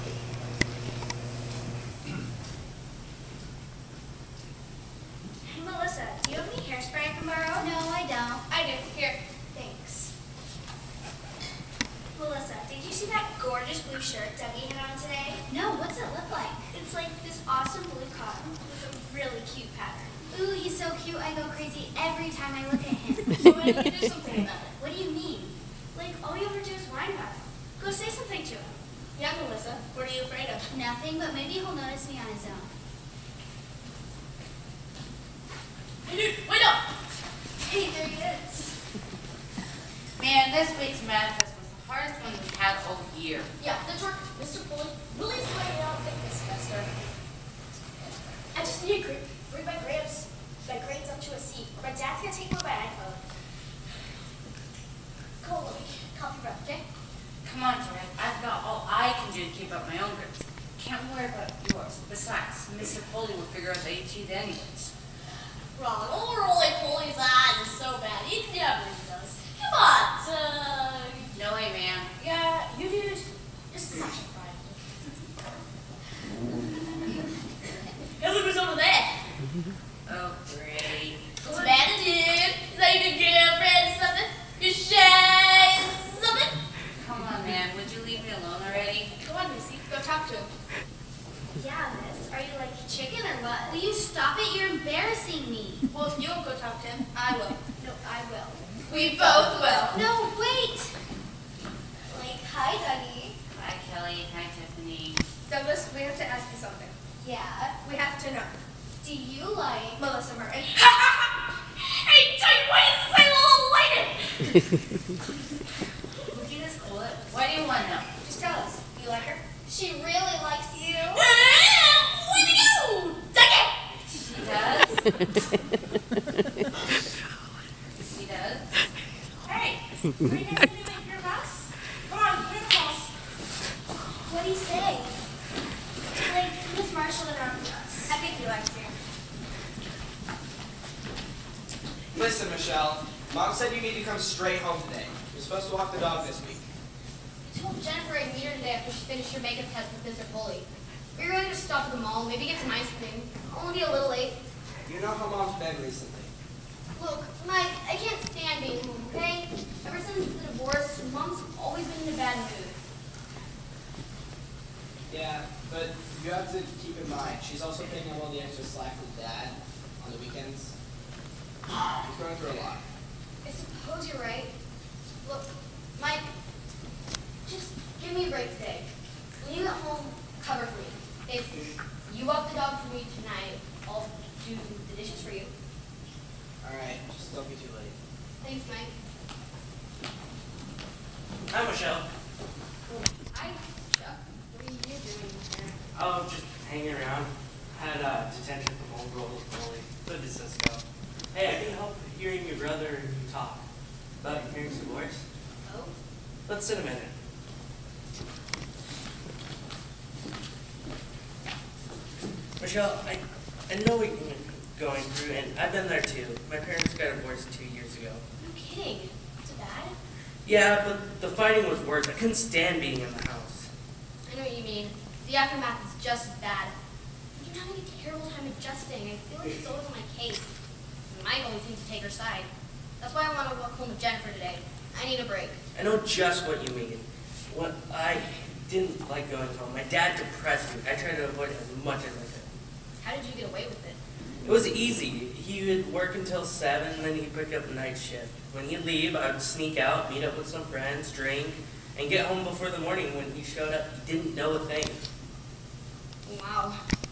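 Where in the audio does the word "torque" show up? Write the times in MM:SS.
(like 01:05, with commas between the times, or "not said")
00:43.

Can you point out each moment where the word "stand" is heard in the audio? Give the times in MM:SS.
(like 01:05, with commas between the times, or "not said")
02:38, 03:42.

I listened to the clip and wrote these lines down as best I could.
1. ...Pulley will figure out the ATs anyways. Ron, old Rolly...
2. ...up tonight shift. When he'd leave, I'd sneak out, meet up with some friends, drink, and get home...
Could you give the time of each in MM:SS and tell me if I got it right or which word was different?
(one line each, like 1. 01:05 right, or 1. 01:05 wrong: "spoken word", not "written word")
1. 01:03 right
2. 04:07 wrong: "night", not "tonight".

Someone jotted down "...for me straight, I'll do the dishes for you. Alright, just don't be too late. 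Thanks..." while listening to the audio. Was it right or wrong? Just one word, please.
wrong.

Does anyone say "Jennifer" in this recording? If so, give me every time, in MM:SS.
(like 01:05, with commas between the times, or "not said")
02:27, 03:54.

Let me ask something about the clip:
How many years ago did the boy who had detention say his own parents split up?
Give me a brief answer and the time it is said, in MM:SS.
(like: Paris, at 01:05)
2, at 03:37.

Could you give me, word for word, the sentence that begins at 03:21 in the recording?
Hey, I can help hearing your brother and you talk about hearing some voice.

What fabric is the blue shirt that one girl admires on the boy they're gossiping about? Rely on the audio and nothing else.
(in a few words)
cotton.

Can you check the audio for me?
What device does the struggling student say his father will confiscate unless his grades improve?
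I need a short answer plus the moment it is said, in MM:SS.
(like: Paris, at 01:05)
iPhone, at 00:52.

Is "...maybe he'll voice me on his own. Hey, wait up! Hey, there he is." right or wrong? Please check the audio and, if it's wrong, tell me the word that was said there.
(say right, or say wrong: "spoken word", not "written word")
wrong: "notice", not "voice".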